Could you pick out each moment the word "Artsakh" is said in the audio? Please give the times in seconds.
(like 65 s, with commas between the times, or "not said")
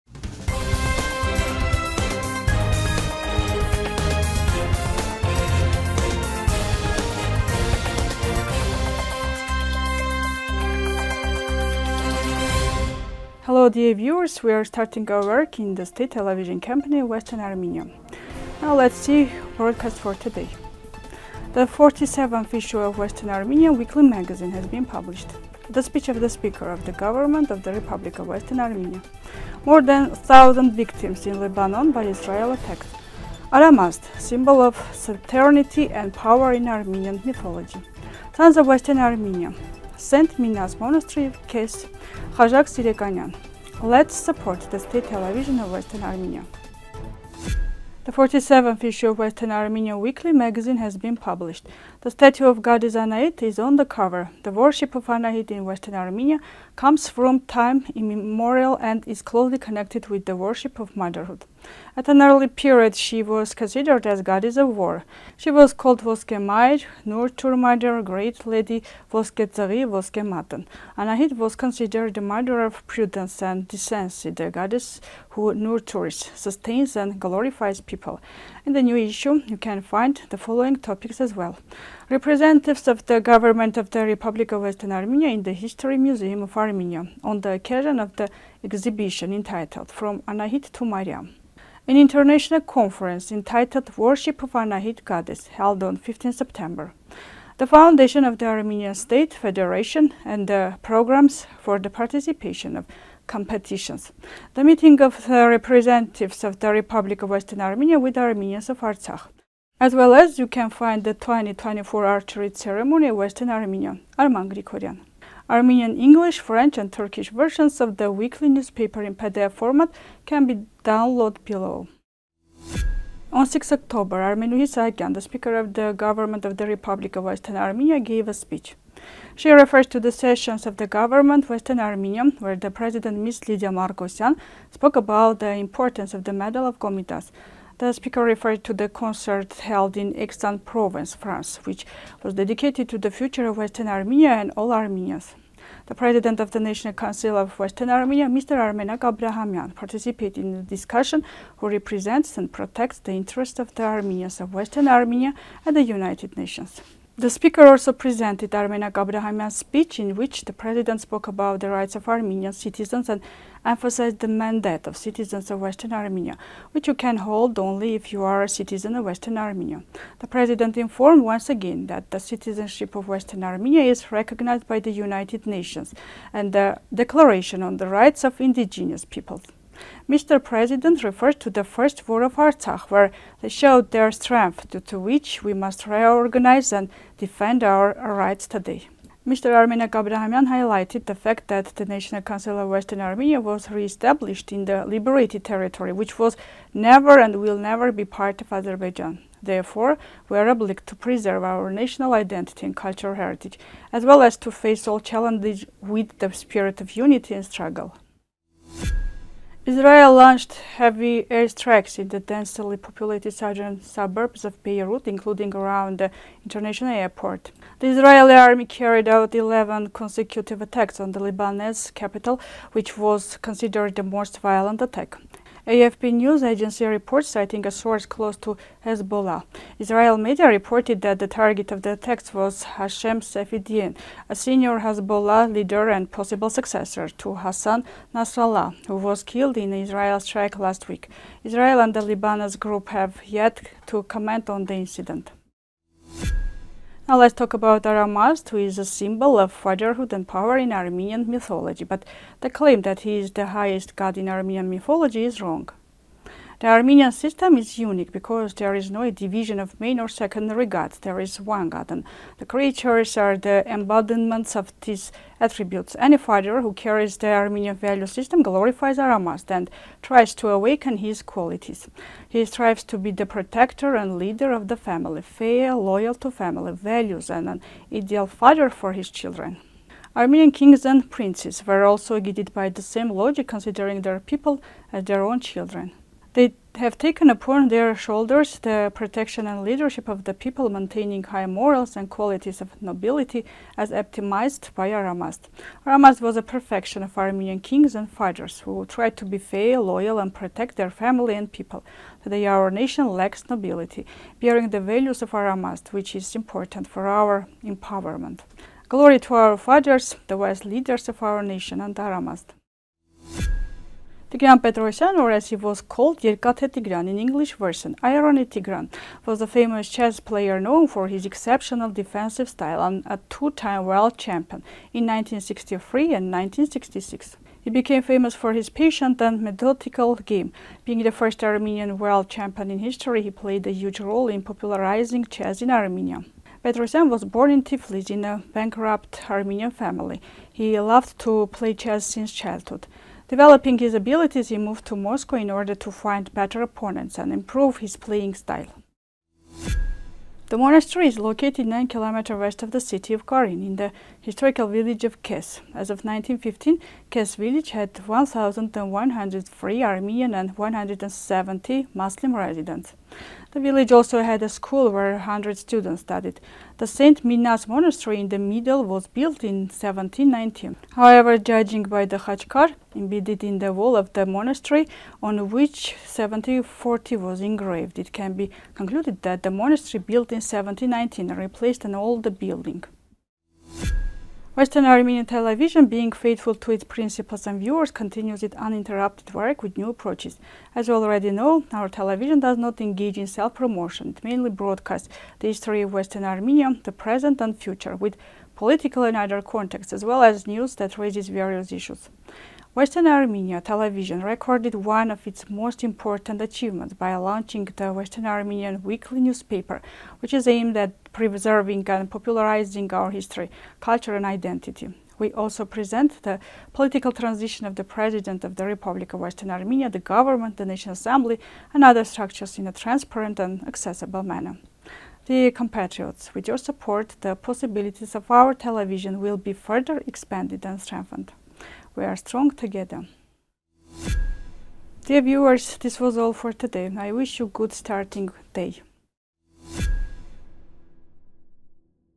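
108 s, 182 s.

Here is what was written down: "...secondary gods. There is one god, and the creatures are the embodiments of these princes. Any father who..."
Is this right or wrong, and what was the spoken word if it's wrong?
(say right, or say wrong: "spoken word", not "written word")
wrong: "attributes", not "princes".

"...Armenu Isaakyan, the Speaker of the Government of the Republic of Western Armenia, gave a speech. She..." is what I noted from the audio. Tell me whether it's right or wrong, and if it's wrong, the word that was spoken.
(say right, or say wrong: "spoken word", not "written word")
right.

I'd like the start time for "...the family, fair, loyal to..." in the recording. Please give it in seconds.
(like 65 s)
274 s.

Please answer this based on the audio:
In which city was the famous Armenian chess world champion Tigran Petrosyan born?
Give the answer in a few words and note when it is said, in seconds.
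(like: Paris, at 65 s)
Tiflis, at 337 s.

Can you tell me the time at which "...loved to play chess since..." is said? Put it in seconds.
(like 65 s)
340 s.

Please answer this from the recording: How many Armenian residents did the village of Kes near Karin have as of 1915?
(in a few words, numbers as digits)
1,103.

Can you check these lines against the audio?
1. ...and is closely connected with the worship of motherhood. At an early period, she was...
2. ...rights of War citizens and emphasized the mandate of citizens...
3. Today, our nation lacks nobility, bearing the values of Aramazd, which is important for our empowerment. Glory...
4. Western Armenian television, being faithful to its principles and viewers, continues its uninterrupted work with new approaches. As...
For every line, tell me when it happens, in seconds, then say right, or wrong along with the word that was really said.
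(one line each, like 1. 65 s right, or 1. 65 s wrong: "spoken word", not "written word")
1. 58 s right
2. 161 s wrong: "Armenian", not "War"
3. 302 s right
4. 384 s right.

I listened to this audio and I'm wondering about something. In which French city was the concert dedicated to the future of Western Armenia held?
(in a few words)
Aix-en-Provence.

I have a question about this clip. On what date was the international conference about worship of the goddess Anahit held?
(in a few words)
15 September.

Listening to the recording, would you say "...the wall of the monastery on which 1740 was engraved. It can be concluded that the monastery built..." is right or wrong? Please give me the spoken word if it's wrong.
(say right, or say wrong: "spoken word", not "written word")
right.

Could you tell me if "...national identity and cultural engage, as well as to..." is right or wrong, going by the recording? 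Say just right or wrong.
wrong.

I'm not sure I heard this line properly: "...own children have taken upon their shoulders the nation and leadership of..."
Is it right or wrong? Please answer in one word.
wrong.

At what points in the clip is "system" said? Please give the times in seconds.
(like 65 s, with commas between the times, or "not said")
257 s, 268 s.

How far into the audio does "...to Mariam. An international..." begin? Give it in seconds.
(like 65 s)
90 s.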